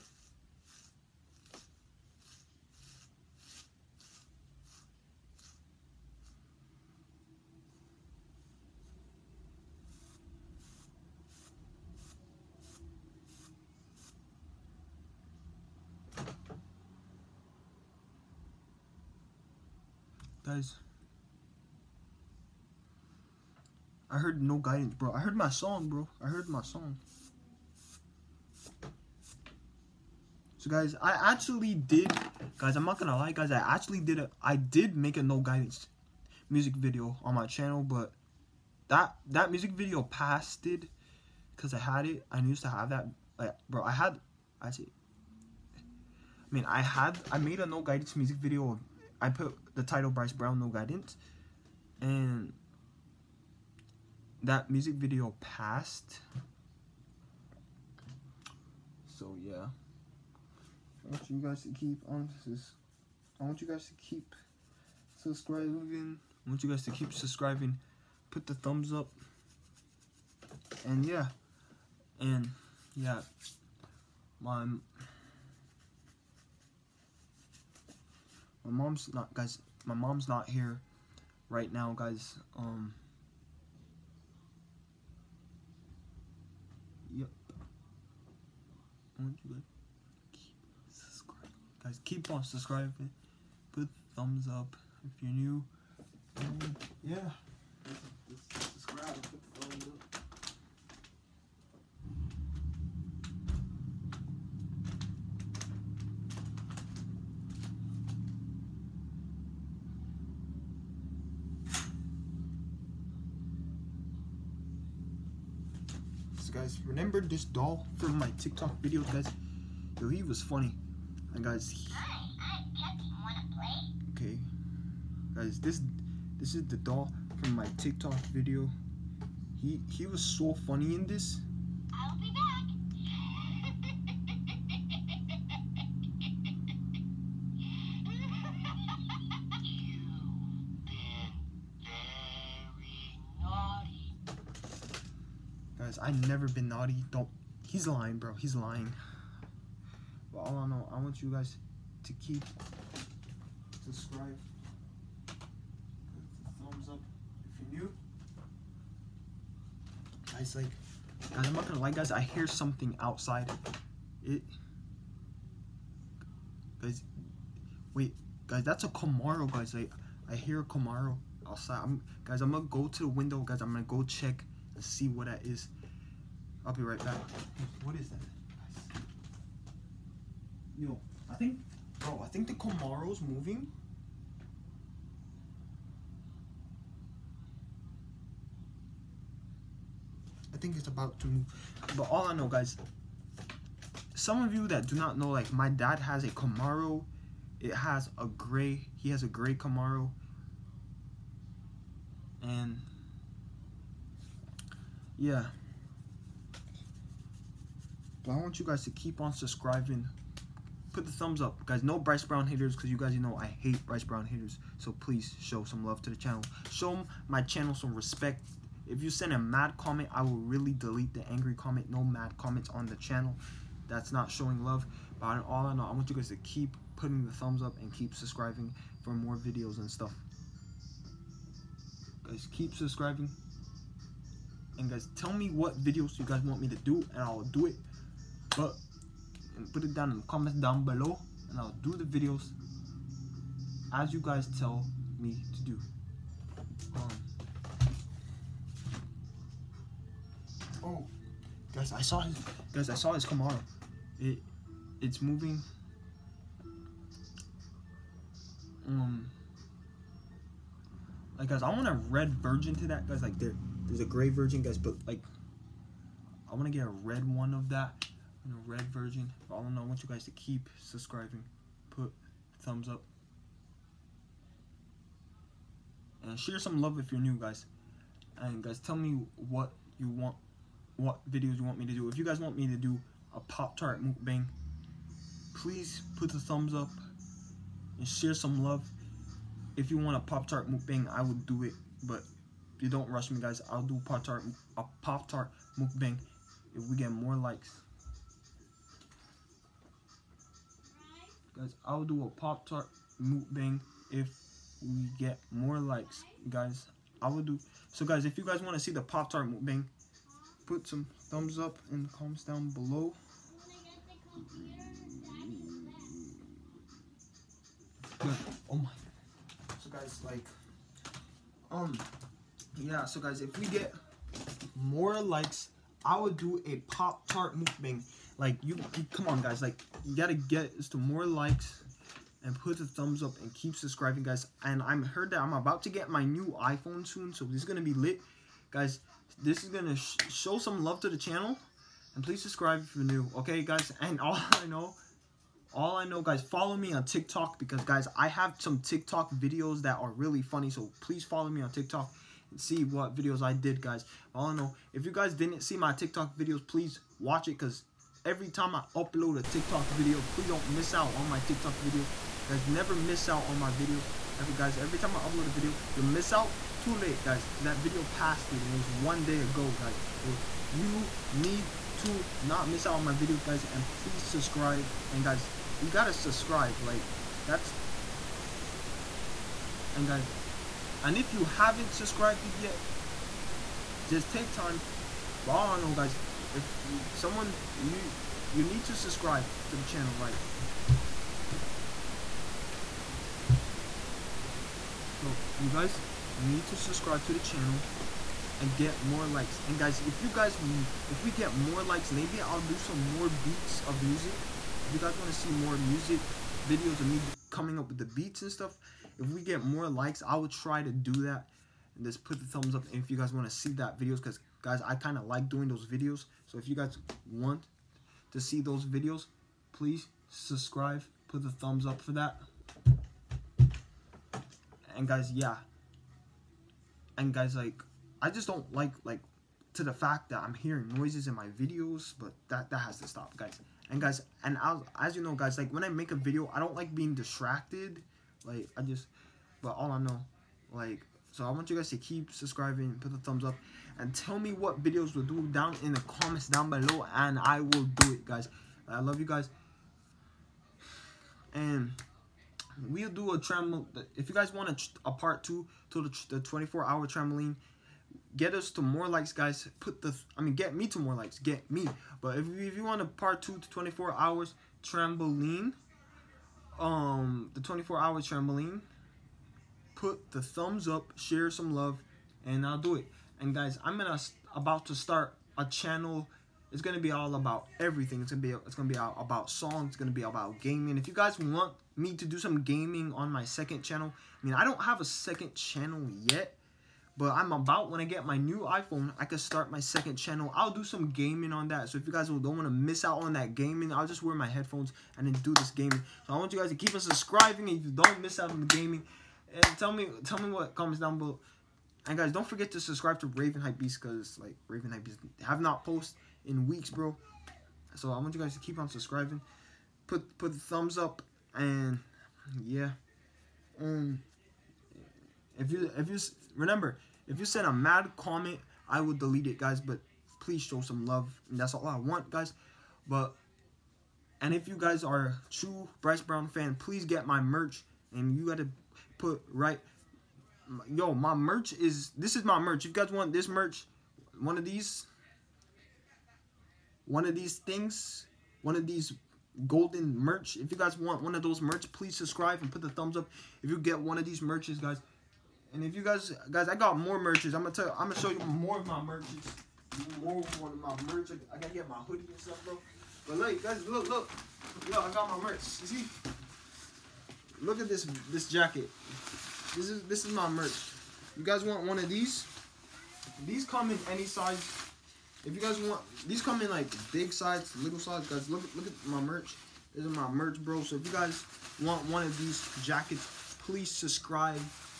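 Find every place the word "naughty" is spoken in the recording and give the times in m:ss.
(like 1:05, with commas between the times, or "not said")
2:26.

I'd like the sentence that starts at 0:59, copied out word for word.
So yeah, I want you guys to keep on this.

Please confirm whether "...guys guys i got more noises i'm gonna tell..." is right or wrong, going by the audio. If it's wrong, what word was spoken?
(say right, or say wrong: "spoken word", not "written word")
wrong: "merches", not "noises".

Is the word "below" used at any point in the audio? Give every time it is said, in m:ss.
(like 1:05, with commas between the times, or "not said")
4:00, 5:12, 7:26, 8:21.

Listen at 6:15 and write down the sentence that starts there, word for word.
And, guys, you got to subscribe.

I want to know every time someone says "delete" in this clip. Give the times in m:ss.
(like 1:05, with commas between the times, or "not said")
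3:40, 8:39.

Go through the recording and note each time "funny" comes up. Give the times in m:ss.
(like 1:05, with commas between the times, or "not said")
2:00, 2:10, 5:50.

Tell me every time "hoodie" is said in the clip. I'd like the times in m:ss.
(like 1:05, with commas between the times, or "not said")
9:11.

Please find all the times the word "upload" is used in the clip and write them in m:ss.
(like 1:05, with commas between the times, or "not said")
5:58, 6:05.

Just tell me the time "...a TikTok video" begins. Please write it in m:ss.
5:59.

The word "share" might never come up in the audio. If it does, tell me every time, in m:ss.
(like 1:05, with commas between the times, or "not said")
4:36, 4:48, 7:51.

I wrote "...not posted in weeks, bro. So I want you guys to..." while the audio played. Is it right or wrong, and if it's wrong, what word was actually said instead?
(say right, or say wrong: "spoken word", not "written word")
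right.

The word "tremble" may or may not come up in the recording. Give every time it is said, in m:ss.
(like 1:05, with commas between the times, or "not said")
7:33.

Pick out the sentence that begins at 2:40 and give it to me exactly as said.
Guys, like, guys, I'm not gonna lie, guys.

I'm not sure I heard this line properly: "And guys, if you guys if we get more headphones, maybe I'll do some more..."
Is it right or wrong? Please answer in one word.
wrong.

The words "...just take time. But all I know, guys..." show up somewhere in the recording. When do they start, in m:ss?
6:24.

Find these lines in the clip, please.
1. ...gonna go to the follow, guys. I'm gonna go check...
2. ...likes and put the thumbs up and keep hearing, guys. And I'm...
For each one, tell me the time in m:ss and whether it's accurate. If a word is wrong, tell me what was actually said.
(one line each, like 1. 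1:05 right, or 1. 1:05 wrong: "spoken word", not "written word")
1. 2:52 wrong: "window", not "follow"
2. 5:31 wrong: "subscribing", not "hearing".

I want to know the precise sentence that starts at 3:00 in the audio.
Yo, I think, bro, I think the Camaro's moving.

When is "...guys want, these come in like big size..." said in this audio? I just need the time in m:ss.
9:25.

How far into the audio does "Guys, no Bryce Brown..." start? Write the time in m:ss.
3:31.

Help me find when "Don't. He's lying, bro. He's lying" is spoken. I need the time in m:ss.
2:27.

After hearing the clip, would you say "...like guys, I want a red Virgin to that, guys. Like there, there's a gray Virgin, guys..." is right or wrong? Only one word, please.
right.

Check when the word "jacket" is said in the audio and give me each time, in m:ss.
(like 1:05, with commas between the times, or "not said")
9:18, 9:32.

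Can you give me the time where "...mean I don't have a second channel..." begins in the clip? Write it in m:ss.
8:04.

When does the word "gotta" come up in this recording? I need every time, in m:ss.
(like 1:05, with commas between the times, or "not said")
5:30, 9:11.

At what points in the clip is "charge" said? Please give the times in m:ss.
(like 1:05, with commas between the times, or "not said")
not said.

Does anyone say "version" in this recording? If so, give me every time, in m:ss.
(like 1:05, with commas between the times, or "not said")
4:28.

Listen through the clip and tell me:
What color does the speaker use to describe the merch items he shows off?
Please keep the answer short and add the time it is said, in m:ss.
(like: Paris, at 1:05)
Golden, at 8:58.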